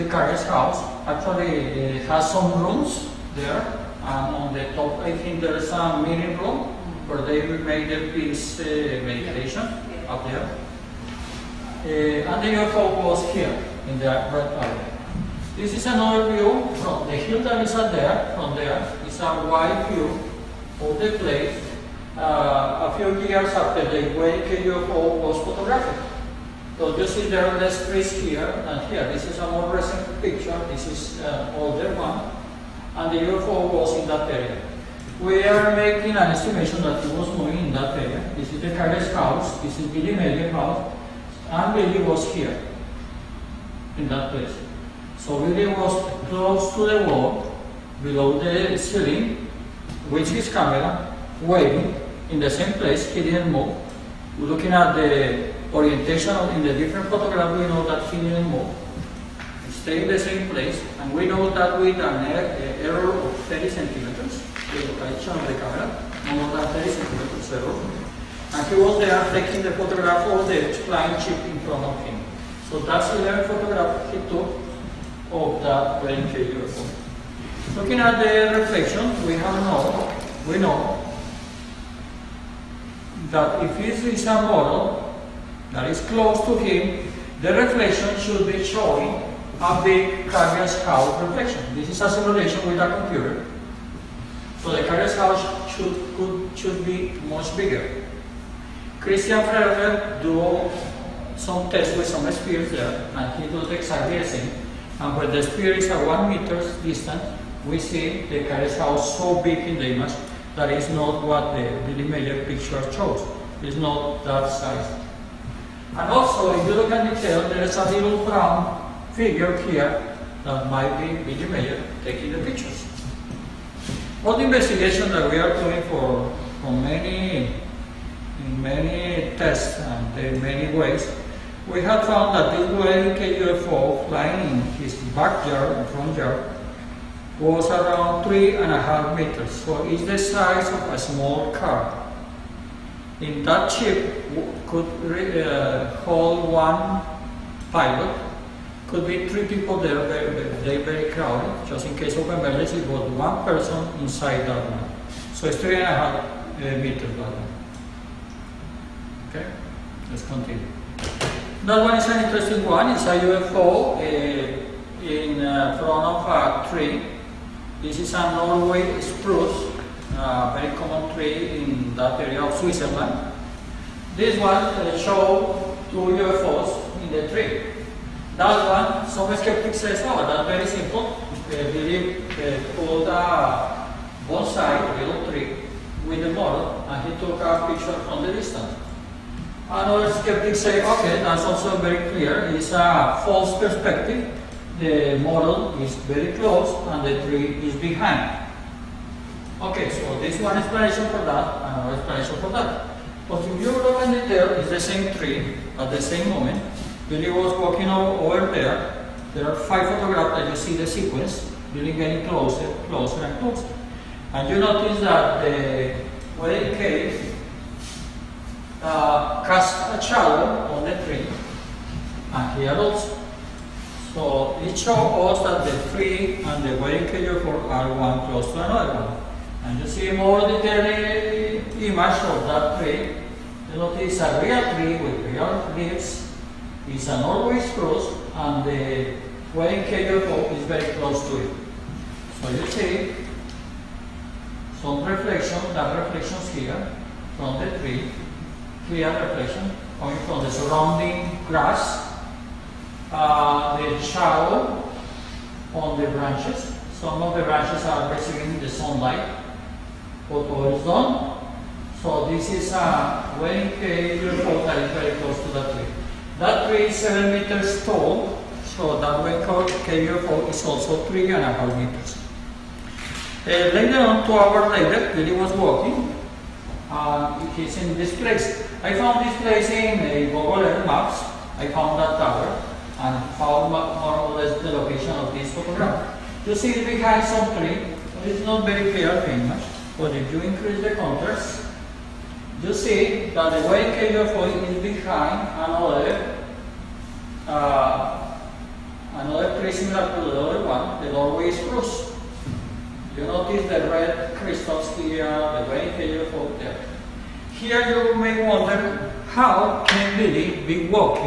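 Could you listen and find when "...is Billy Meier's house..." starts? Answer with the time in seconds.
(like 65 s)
39 s.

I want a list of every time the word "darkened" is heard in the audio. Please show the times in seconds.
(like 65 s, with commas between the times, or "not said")
not said.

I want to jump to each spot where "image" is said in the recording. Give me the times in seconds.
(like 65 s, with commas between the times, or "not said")
109 s, 230 s.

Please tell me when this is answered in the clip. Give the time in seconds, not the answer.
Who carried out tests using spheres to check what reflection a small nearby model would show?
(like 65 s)
99 s.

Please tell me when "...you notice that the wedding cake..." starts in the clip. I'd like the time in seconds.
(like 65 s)
214 s.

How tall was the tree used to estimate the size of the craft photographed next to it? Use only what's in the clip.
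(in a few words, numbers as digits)
7 meters.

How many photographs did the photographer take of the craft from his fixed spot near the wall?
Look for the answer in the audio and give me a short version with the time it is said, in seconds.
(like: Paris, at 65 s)
11, at 73 s.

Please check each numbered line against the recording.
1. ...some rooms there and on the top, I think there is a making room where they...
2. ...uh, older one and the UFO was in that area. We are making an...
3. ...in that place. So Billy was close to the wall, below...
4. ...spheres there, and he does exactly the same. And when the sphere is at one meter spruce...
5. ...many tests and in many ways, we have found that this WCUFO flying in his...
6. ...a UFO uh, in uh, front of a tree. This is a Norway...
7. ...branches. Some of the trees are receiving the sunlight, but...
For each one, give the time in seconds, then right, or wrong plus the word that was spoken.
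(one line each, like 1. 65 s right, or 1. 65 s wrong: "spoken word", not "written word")
1. 2 s wrong: "meeting", not "making"
2. 31 s right
3. 43 s right
4. 102 s wrong: "distance", not "spruce"
5. 128 s right
6. 163 s right
7. 256 s wrong: "branches", not "trees".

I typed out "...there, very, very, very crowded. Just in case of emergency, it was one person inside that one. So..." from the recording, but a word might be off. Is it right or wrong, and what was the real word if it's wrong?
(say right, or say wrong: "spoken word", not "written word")
right.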